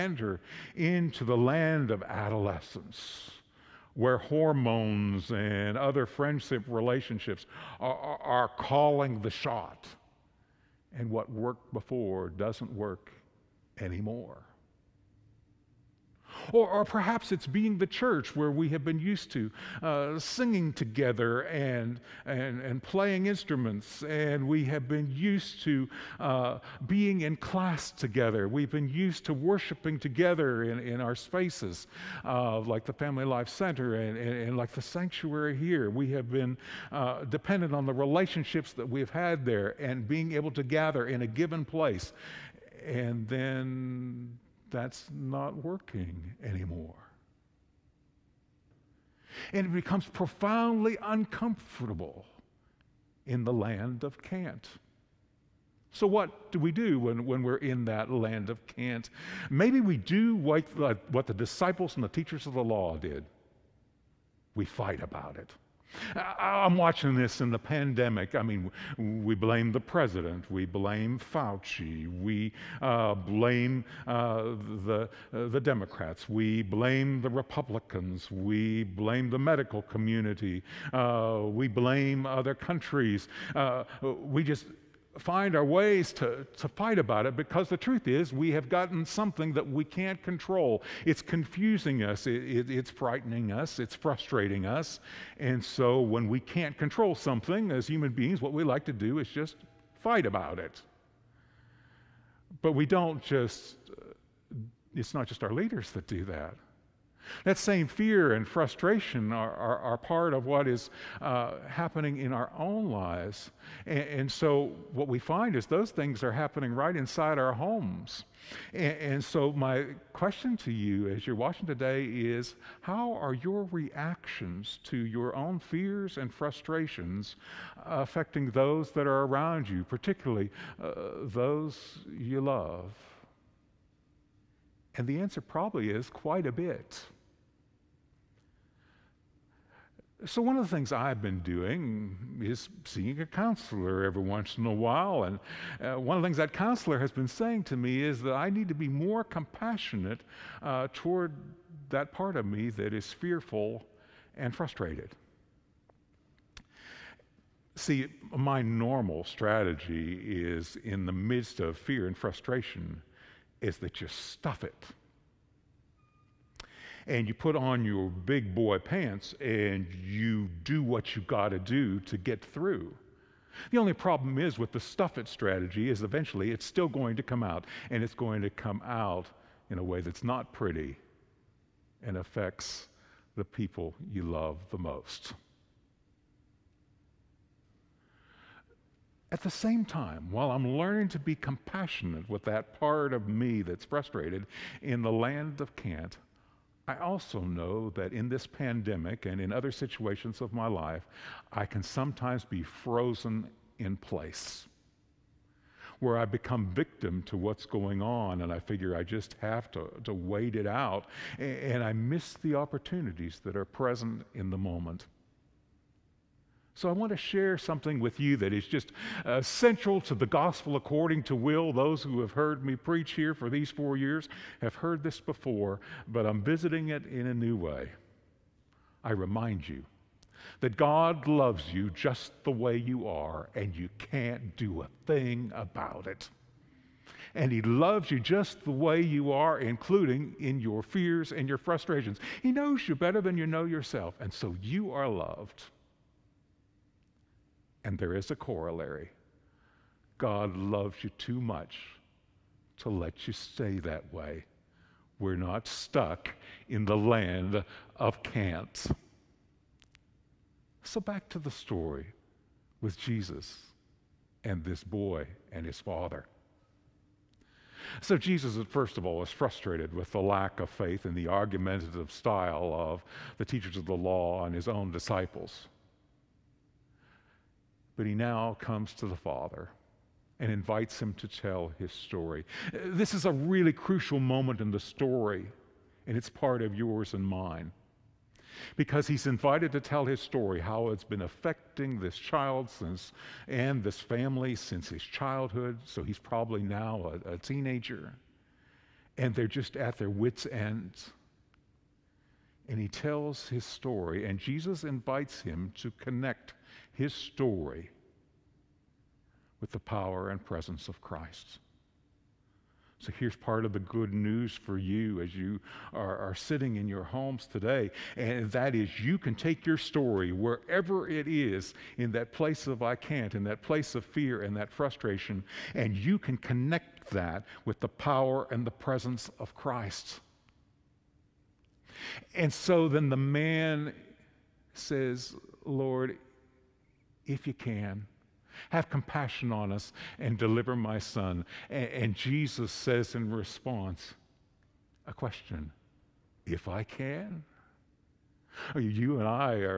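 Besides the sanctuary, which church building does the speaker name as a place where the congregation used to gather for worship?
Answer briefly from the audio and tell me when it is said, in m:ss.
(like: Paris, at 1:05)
Family Life Center, at 0:32.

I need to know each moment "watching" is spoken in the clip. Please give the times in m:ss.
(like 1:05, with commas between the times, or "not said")
1:06, 2:01.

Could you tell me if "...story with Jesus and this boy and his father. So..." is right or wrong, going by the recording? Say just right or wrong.
right.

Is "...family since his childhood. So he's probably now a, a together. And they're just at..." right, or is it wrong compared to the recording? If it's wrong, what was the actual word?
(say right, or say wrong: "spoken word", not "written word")
wrong: "teenager", not "together".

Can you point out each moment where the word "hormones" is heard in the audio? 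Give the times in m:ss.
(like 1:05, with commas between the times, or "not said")
0:04.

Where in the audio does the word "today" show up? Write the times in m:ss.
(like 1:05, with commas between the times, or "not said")
2:01, 5:17.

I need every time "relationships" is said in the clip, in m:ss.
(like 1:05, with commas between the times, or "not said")
0:06, 0:37.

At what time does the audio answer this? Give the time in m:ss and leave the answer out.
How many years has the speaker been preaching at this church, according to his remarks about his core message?
3:43.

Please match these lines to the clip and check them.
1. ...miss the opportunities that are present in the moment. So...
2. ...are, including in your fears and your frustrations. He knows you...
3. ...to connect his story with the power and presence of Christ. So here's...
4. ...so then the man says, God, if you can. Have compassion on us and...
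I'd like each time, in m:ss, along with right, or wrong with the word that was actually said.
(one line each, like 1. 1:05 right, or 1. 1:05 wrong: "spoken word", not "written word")
1. 3:31 right
2. 3:59 right
3. 5:05 right
4. 5:32 wrong: "Lord", not "God".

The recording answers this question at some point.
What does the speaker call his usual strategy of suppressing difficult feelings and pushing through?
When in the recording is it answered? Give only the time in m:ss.
2:54.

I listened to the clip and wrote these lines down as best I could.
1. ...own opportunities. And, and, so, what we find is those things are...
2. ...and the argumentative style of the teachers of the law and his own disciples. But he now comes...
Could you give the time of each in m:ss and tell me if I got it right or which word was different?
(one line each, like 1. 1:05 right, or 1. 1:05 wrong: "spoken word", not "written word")
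1. 1:52 wrong: "lives", not "opportunities"
2. 4:31 right.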